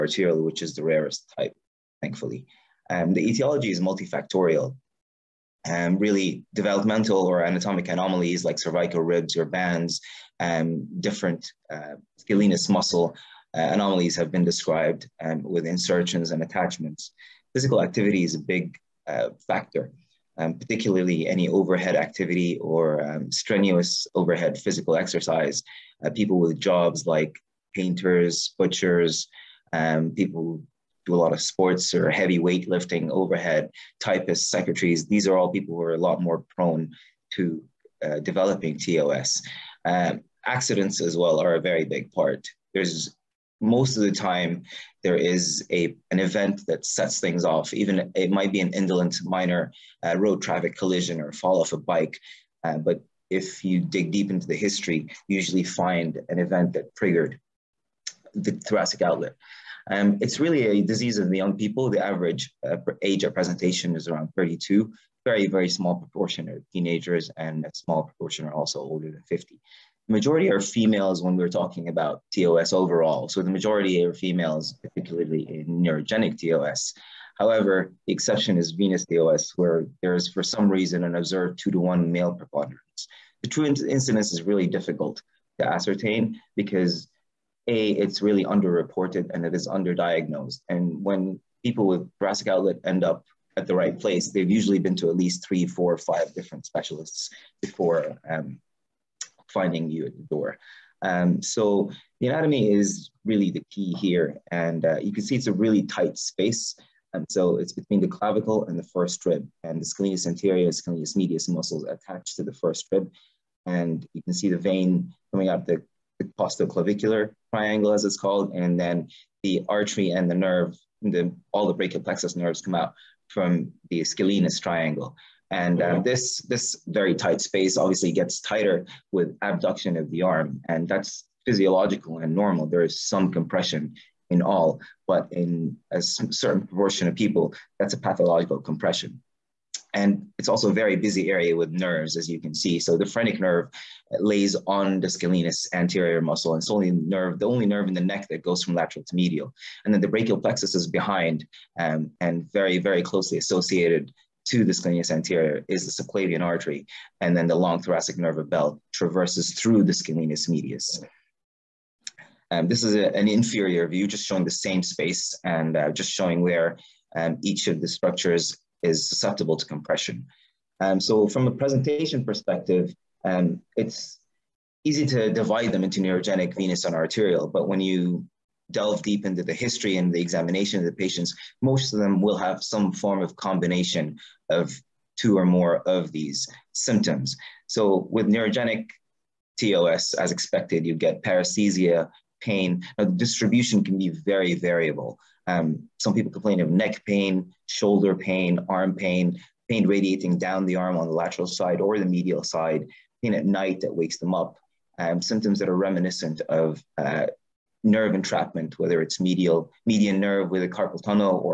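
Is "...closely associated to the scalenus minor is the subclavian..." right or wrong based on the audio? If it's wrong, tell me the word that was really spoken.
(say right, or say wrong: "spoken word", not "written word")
wrong: "anterior", not "minor".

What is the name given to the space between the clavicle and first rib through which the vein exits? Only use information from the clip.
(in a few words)
Costoclavicular triangle.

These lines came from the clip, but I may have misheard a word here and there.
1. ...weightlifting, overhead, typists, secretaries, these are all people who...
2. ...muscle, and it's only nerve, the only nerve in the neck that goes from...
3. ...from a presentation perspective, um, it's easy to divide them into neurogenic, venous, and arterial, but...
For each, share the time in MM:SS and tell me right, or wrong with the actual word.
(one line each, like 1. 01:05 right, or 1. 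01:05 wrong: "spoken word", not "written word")
1. 00:32 right
2. 02:26 right
3. 02:51 right.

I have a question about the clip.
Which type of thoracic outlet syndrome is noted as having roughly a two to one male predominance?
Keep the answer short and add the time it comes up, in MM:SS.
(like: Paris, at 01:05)
Venous TOS, at 01:18.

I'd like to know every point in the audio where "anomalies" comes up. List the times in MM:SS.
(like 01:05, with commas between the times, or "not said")
00:07, 00:13.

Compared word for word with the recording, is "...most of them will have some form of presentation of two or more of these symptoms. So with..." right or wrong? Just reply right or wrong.
wrong.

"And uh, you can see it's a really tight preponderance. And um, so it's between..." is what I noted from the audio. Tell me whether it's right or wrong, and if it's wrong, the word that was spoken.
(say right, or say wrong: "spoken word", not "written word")
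wrong: "space", not "preponderance".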